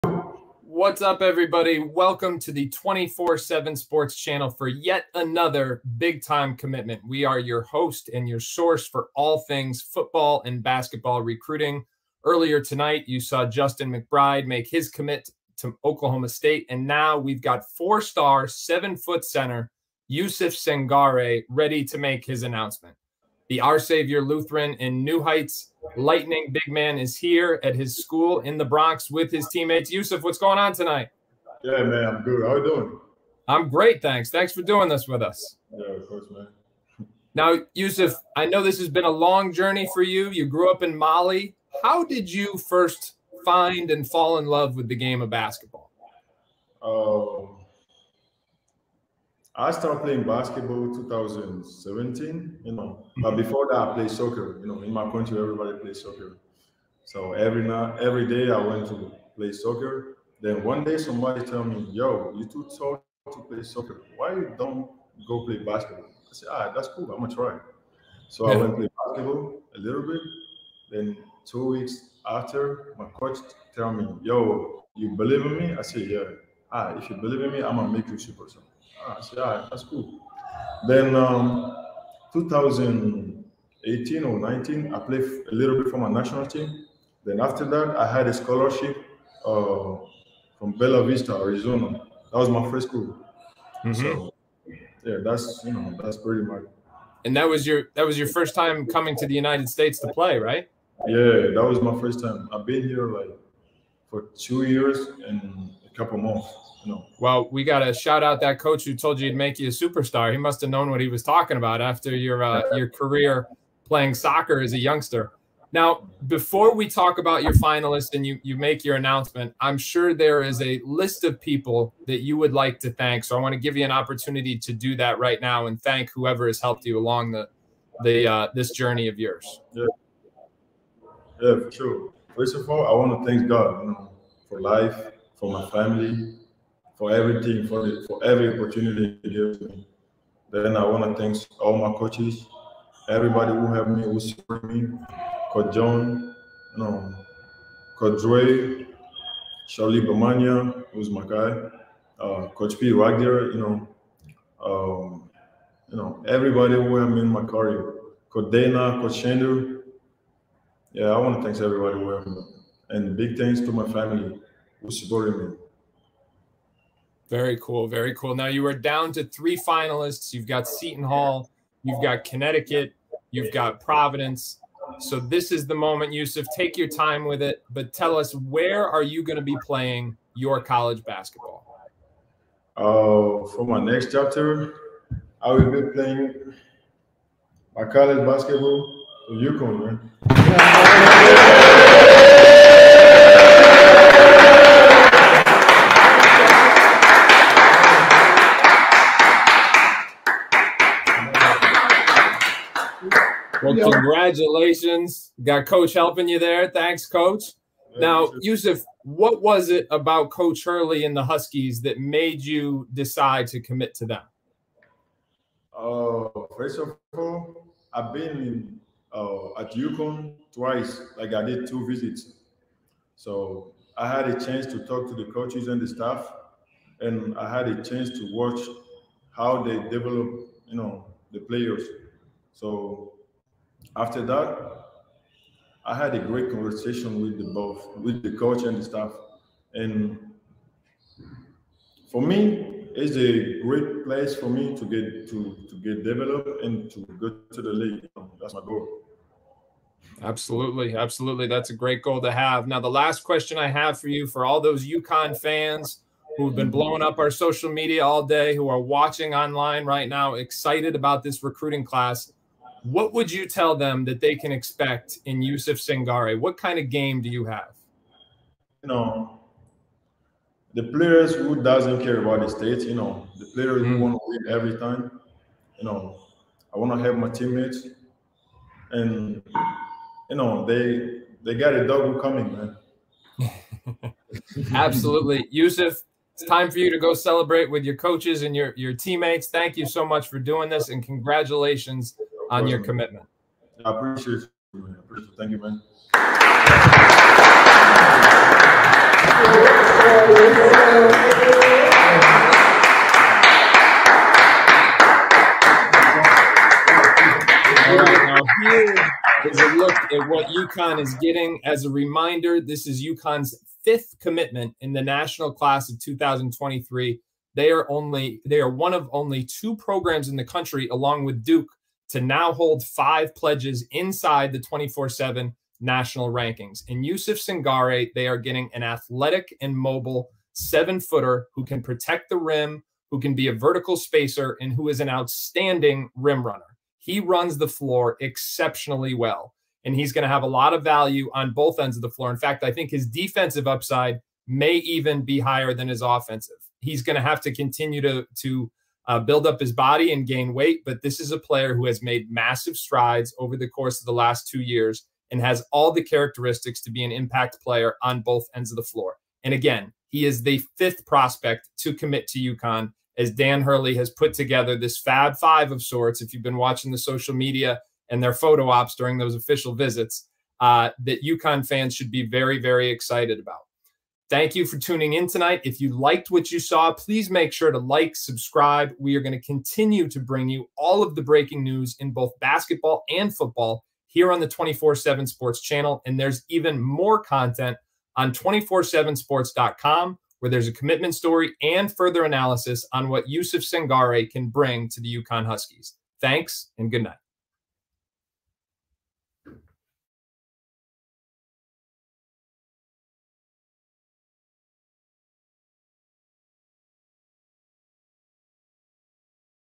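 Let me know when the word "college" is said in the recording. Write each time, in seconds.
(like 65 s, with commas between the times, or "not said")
180 s, 187 s.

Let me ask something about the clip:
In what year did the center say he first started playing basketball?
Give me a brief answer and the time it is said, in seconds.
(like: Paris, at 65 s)
2017, at 50 s.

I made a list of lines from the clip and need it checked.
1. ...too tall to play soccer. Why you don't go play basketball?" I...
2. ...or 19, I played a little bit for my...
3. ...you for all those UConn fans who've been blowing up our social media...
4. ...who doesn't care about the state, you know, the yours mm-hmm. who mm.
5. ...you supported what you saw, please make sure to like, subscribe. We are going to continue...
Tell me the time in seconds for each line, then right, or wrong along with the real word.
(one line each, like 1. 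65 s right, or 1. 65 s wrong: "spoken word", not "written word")
1. 62 s right
2. 84 s right
3. 254 s right
4. 271 s wrong: "players", not "yours"
5. 375 s wrong: "liked", not "supported".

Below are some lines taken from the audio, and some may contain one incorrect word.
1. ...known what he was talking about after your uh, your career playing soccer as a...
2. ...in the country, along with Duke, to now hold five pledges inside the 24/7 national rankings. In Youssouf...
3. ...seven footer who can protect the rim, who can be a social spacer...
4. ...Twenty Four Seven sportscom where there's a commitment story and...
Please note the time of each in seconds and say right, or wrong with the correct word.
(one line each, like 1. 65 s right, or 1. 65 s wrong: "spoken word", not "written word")
1. 110 s right
2. 320 s right
3. 330 s wrong: "vertical", not "social"
4. 388 s right.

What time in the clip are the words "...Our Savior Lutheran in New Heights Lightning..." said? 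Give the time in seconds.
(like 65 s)
23 s.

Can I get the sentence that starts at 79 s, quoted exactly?
Ah, I said, all right, that's cool.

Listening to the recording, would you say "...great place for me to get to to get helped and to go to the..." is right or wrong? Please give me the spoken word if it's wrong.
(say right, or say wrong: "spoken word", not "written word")
wrong: "developed", not "helped".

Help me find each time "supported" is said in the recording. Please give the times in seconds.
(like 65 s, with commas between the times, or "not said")
144 s, 164 s.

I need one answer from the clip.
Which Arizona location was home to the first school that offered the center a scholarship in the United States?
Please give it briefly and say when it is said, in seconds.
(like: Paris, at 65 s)
Bella Vista, at 90 s.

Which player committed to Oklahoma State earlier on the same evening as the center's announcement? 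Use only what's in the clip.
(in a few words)
Justin McBride.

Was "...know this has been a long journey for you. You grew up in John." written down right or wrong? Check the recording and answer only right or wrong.
wrong.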